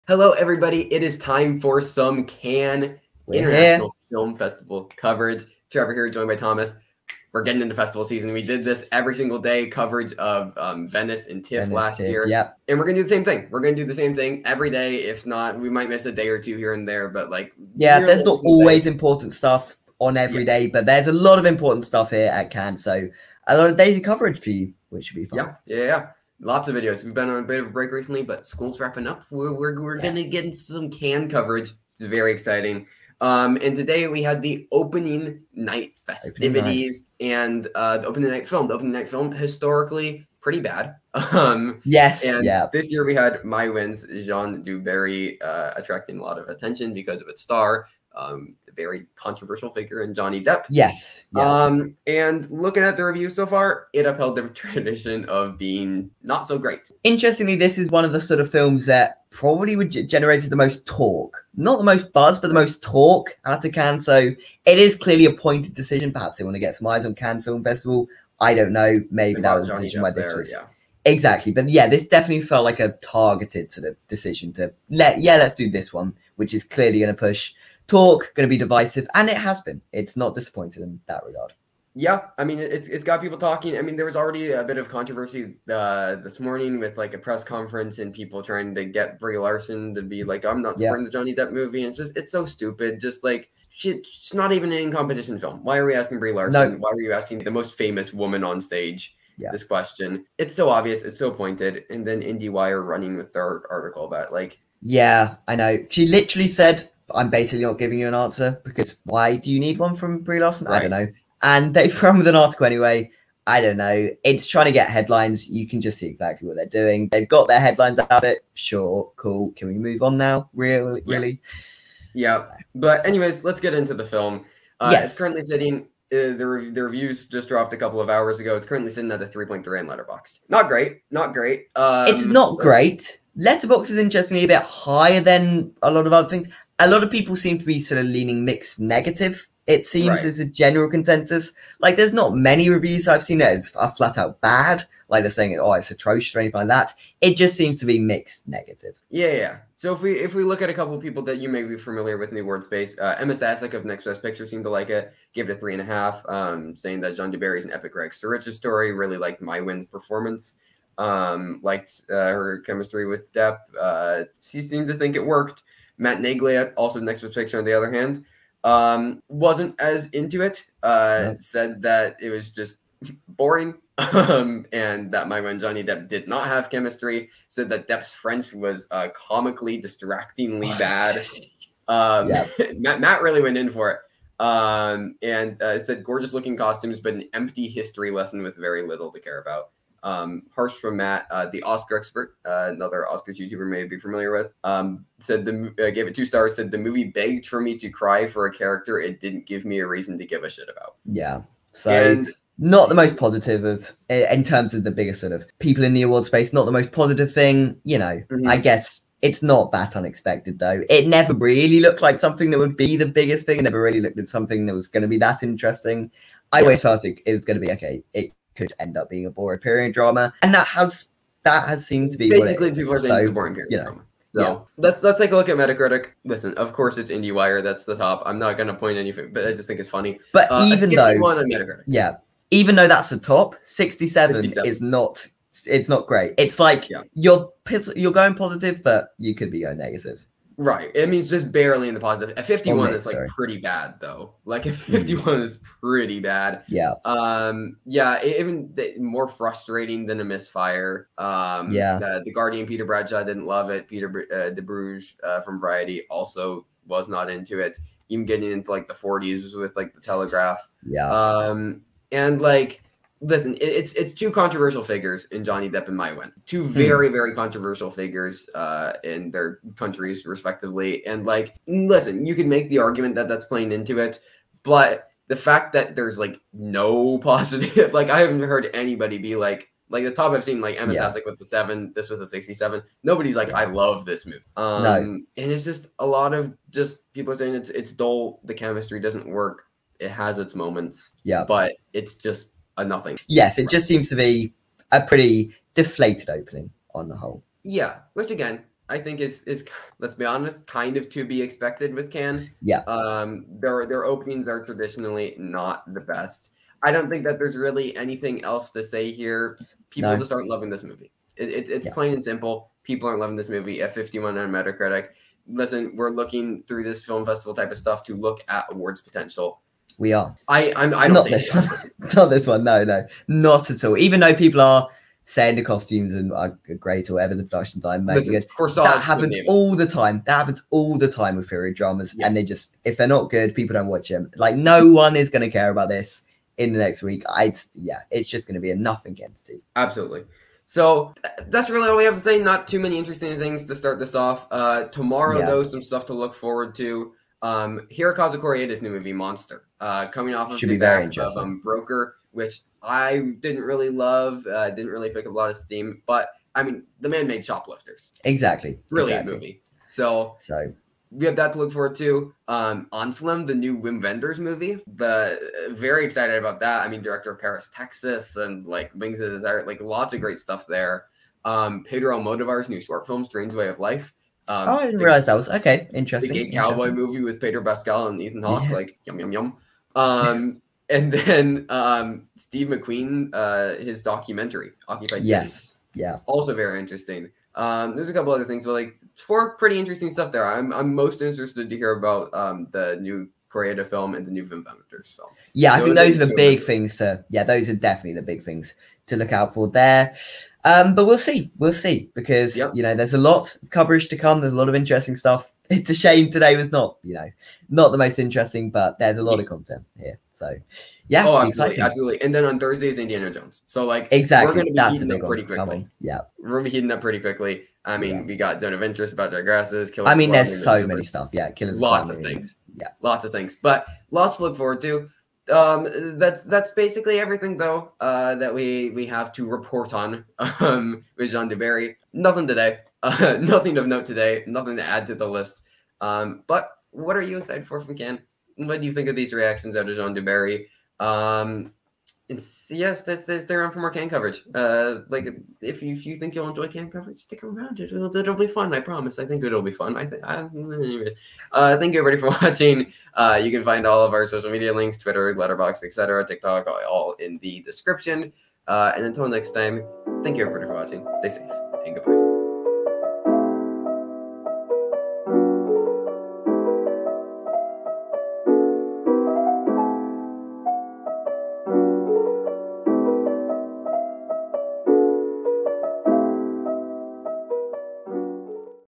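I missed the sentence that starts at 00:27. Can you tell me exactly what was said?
We've been on a bit of a break recently, but school's wrapping up.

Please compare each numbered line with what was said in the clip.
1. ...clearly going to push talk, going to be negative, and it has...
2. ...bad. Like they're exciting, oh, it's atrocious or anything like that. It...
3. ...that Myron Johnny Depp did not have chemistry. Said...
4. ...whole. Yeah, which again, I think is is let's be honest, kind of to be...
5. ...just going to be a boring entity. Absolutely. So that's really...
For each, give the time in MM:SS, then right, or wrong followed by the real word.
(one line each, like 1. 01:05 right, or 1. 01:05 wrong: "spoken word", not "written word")
1. 01:16 wrong: "divisive", not "negative"
2. 02:24 wrong: "saying", not "exciting"
3. 02:55 right
4. 04:57 right
5. 05:38 wrong: "nothing", not "boring".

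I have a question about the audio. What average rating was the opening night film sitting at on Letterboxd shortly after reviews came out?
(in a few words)
3.3.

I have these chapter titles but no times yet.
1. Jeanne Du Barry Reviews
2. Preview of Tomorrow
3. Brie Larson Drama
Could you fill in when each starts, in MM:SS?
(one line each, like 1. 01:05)
1. 02:03
2. 05:44
3. 01:25.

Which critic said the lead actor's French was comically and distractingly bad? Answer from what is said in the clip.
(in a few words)
Matt Neglia.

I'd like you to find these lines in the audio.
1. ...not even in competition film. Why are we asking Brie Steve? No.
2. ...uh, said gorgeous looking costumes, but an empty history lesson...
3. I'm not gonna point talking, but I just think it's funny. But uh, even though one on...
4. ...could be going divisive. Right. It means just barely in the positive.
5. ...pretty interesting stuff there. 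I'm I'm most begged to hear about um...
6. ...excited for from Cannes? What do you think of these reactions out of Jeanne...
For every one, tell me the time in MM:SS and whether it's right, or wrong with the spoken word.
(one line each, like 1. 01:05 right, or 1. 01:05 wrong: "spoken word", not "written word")
1. 01:34 wrong: "Larson", not "Steve"
2. 03:05 right
3. 03:48 wrong: "anything", not "talking"
4. 03:59 wrong: "negative", not "divisive"
5. 06:29 wrong: "interested", not "begged"
6. 07:17 right.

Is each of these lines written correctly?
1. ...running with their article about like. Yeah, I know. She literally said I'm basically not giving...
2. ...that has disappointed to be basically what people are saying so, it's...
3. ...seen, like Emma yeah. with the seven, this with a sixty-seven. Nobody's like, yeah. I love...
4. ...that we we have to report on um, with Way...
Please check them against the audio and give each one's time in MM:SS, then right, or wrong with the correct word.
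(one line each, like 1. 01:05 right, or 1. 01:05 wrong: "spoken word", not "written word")
1. 01:42 right
2. 03:41 wrong: "seemed", not "disappointed"
3. 04:40 right
4. 07:08 wrong: "Jeanne", not "Way".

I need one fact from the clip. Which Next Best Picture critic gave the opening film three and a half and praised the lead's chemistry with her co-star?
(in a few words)
Emma Sasek.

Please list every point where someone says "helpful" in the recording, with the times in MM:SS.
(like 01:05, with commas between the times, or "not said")
not said.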